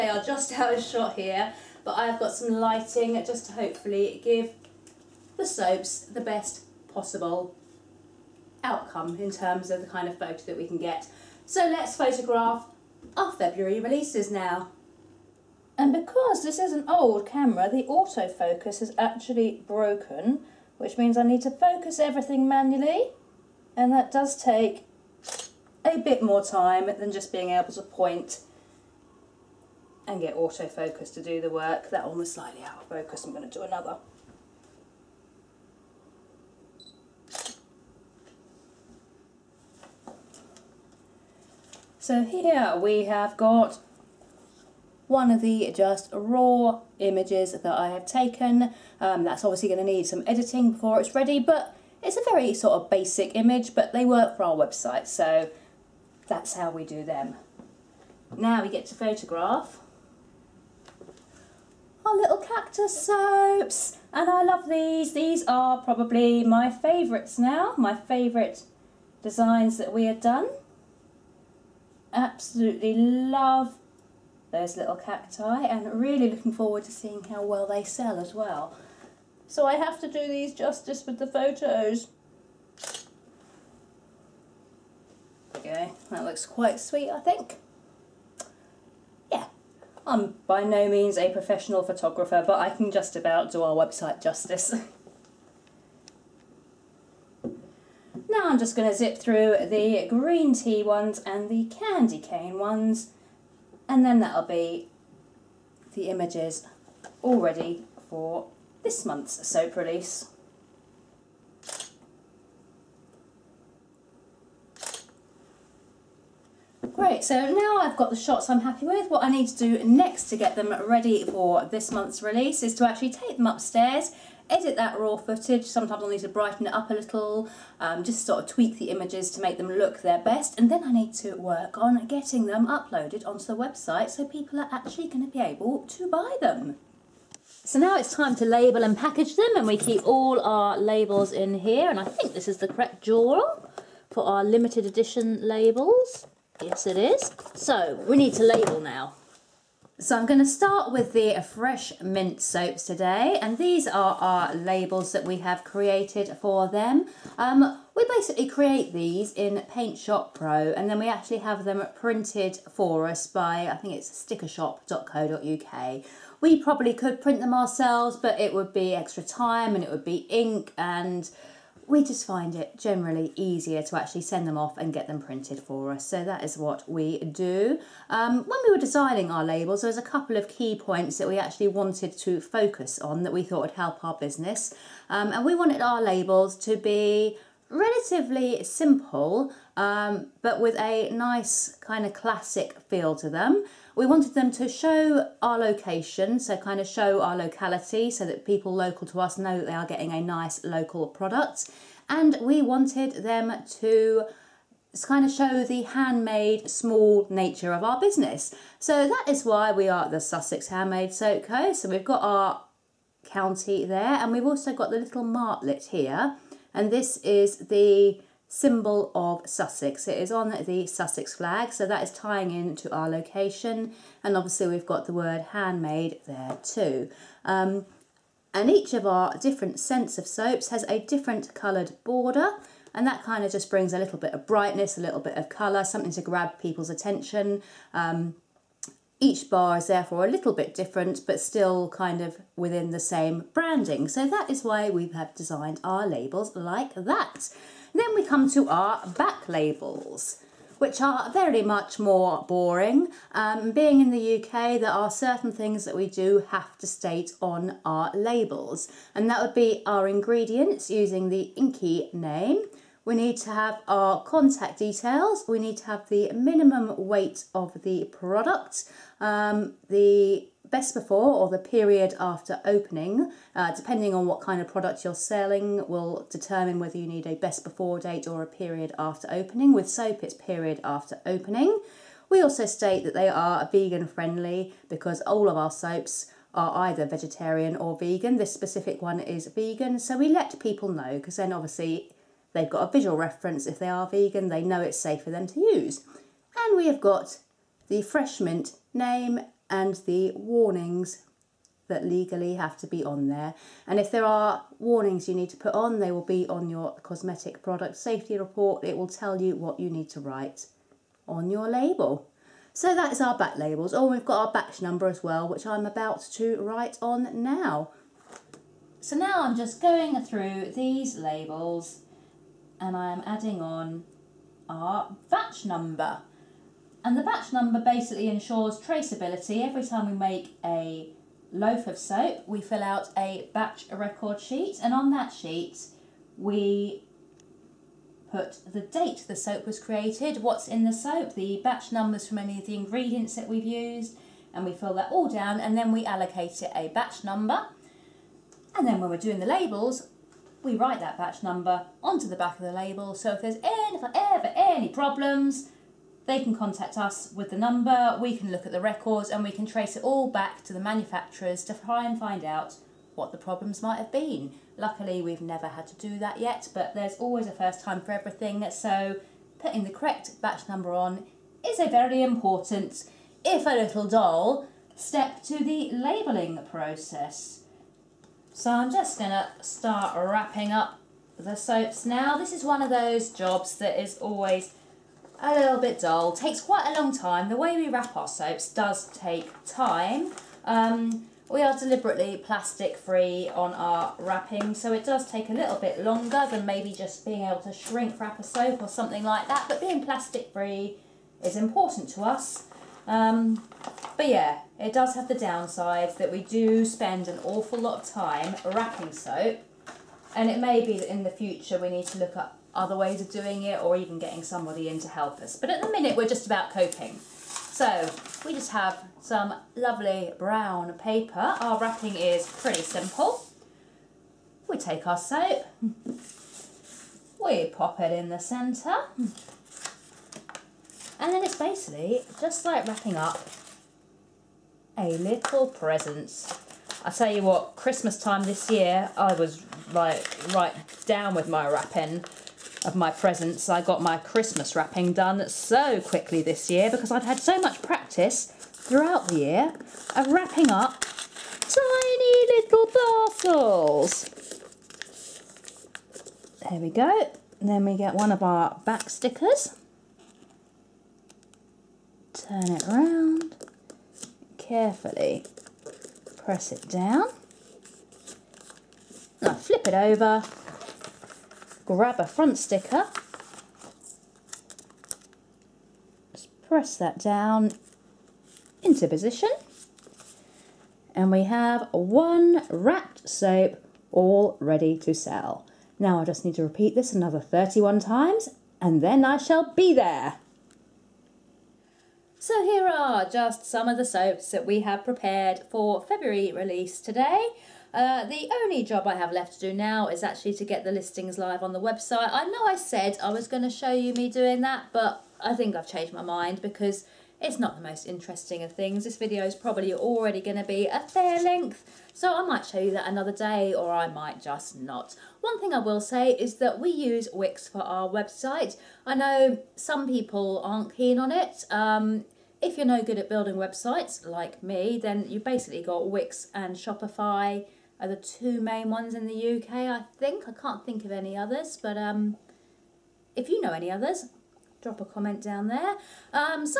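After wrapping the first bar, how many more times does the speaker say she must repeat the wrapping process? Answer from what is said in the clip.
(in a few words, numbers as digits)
31.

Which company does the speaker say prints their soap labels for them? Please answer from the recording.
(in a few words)
stickershop.co.uk.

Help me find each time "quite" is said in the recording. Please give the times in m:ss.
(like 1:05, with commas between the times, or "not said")
1:26, 6:26.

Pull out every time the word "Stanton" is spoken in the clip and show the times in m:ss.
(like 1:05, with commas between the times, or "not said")
not said.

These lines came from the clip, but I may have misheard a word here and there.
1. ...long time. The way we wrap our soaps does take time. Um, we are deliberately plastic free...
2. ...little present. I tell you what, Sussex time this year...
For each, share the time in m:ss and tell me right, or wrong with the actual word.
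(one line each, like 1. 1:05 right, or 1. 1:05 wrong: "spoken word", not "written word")
1. 6:27 right
2. 7:15 wrong: "Christmas", not "Sussex".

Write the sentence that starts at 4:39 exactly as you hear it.
With soap, it's period after opening.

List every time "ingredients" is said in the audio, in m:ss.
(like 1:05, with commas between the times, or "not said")
4:20, 5:42.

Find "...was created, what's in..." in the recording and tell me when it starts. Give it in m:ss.
5:39.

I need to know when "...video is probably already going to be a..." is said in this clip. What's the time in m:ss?
8:29.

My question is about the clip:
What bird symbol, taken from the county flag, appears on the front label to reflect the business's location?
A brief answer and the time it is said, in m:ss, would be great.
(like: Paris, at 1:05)
martlet, at 3:35.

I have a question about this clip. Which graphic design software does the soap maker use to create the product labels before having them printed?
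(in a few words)
Paint Shop Pro.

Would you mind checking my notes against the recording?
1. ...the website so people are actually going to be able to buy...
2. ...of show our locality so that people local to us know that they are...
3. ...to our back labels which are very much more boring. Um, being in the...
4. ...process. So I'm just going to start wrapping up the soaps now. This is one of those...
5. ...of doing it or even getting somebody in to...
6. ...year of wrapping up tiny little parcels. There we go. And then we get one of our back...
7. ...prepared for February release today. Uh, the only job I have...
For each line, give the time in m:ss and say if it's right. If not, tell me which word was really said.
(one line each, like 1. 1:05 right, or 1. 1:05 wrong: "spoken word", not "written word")
1. 2:13 right
2. 3:16 right
3. 4:08 right
4. 6:16 right
5. 6:53 right
6. 7:29 right
7. 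8:15 right.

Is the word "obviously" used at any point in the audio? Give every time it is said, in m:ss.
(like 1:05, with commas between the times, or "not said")
0:49, 3:44, 4:51.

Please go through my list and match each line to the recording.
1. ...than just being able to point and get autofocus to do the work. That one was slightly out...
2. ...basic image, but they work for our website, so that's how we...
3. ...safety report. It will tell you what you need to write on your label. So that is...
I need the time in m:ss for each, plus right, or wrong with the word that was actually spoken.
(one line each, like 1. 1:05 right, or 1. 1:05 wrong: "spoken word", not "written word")
1. 0:26 right
2. 0:52 right
3. 5:07 right.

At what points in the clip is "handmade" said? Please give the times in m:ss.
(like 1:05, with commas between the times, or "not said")
3:25, 3:30, 3:45.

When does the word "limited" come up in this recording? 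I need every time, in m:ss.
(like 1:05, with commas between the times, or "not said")
2:24.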